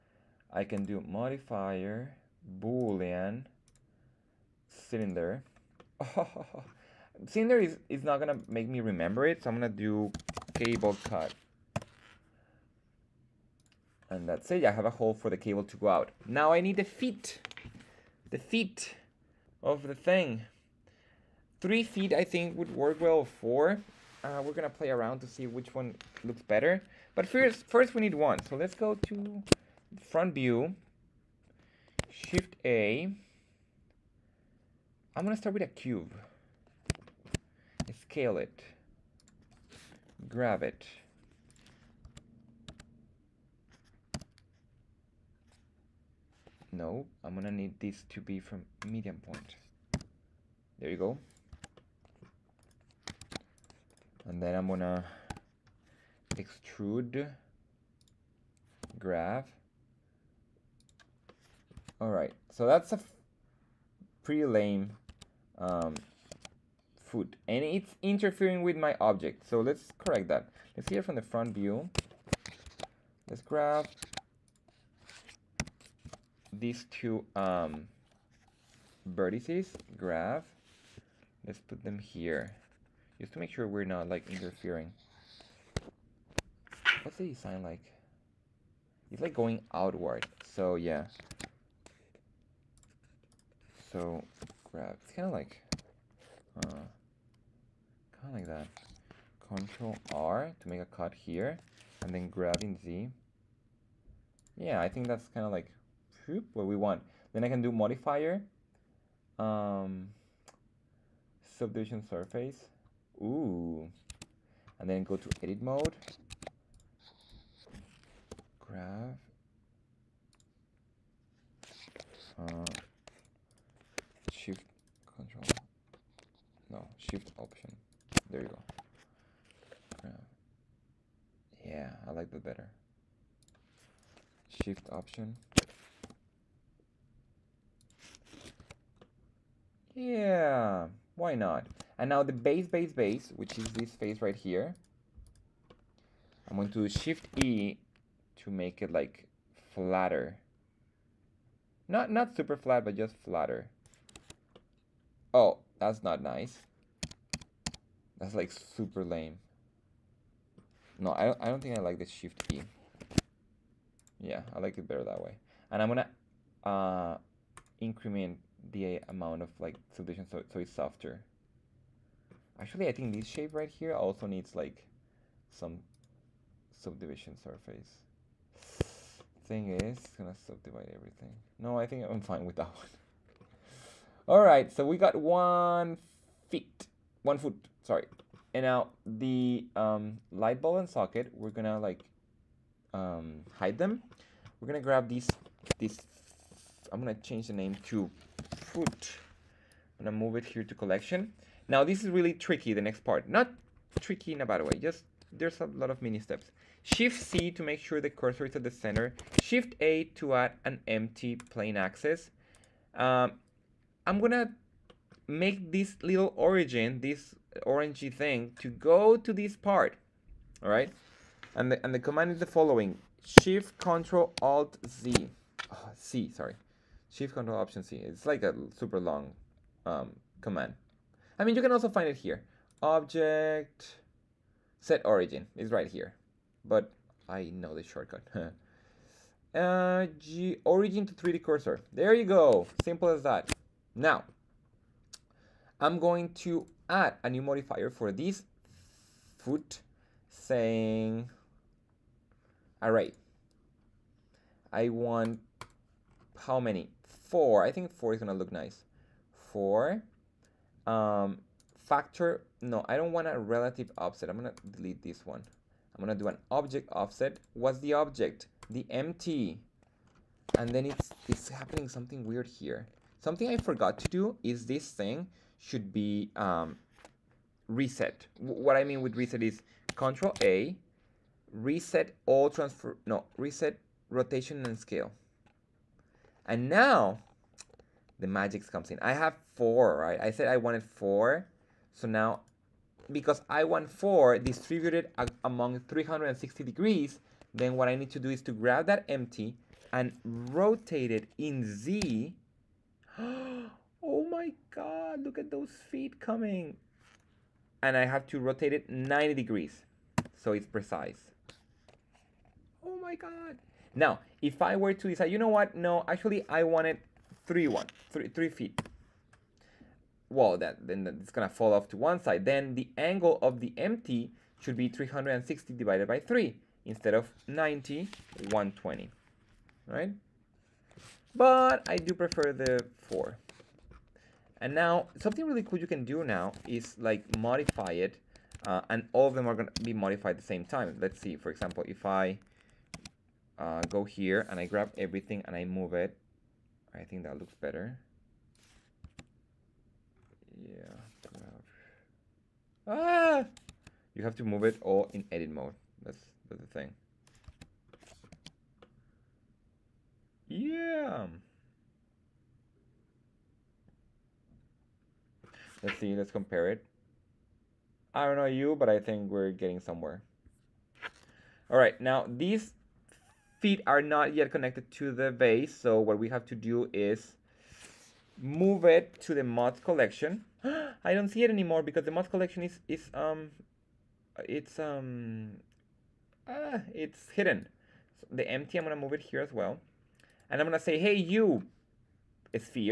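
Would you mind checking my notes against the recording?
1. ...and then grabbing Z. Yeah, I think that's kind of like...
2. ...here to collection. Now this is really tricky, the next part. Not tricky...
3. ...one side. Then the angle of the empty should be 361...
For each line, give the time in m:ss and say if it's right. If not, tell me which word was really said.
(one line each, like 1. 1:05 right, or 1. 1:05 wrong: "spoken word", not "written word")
1. 1:42 right
2. 3:20 right
3. 5:21 wrong: "360", not "361".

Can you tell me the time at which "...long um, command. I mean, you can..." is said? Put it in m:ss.
3:48.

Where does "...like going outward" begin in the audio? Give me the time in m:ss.
1:29.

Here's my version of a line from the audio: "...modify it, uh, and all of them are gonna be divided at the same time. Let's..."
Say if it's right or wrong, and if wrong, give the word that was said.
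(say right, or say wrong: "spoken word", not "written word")
wrong: "modified", not "divided".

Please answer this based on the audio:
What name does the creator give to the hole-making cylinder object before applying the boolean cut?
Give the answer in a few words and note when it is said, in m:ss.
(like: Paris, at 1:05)
cable cut, at 0:10.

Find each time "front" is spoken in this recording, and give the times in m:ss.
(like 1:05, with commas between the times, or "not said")
0:30, 1:11.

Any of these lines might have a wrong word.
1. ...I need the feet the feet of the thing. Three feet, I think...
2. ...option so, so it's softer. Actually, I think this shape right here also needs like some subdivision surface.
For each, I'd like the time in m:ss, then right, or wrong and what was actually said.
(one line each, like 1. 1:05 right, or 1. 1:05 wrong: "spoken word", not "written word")
1. 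0:16 right
2. 2:49 wrong: "solution", not "option".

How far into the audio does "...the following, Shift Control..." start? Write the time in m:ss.
3:42.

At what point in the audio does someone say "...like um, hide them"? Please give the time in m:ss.
3:11.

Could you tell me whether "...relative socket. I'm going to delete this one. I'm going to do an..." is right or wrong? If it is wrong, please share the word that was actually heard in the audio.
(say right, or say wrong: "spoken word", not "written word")
wrong: "offset", not "socket".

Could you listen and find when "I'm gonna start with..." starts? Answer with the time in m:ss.
0:35.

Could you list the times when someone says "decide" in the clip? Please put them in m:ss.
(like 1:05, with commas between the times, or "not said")
5:15.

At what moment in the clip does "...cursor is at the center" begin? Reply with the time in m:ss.
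3:28.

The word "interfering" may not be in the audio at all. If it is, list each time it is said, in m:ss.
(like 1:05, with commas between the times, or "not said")
1:08, 1:24.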